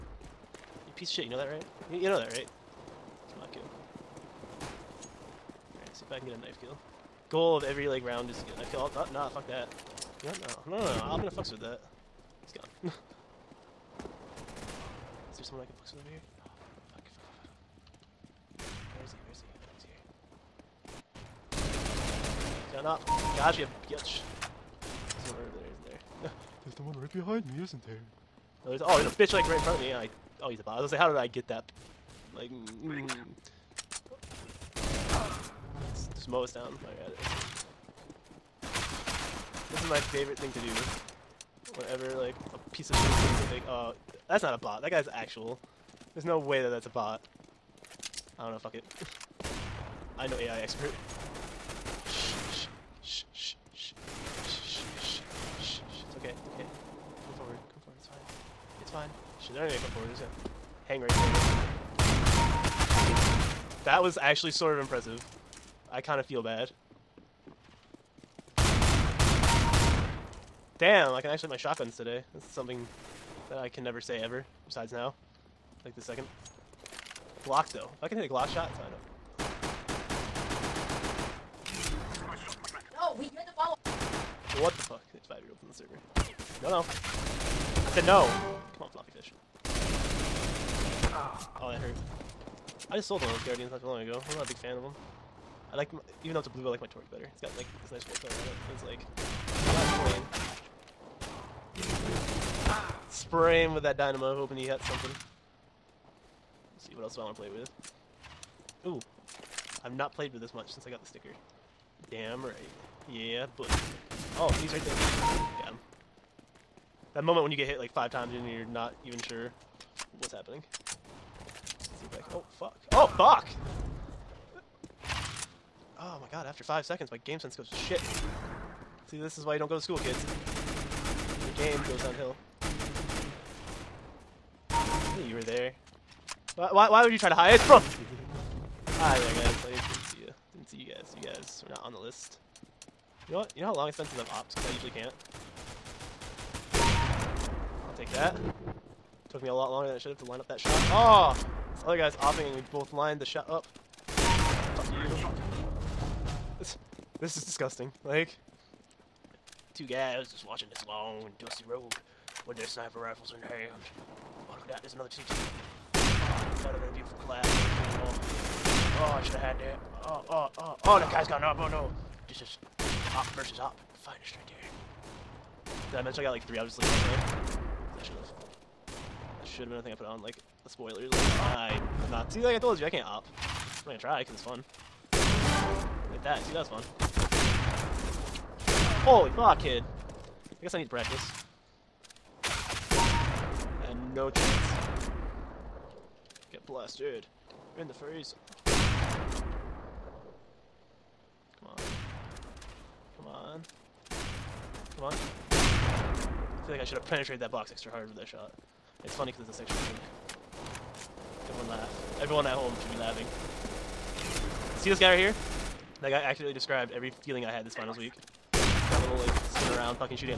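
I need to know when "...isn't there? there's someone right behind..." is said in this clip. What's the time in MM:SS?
00:25.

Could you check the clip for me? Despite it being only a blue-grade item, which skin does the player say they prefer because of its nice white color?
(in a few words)
Torque.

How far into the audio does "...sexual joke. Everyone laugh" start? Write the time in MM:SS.
03:29.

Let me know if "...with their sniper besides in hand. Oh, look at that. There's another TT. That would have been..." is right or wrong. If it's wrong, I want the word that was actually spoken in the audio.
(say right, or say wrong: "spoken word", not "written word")
wrong: "rifles", not "besides".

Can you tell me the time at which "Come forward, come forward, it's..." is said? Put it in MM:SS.
00:57.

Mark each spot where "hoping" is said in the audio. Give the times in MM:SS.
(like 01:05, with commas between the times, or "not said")
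01:44.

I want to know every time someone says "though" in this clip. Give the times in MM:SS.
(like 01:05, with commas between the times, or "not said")
01:17, 01:36.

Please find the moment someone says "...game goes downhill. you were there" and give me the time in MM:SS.
02:11.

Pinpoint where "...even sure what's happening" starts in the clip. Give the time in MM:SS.
01:59.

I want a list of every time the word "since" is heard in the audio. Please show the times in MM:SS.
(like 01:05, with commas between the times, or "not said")
01:50, 02:24.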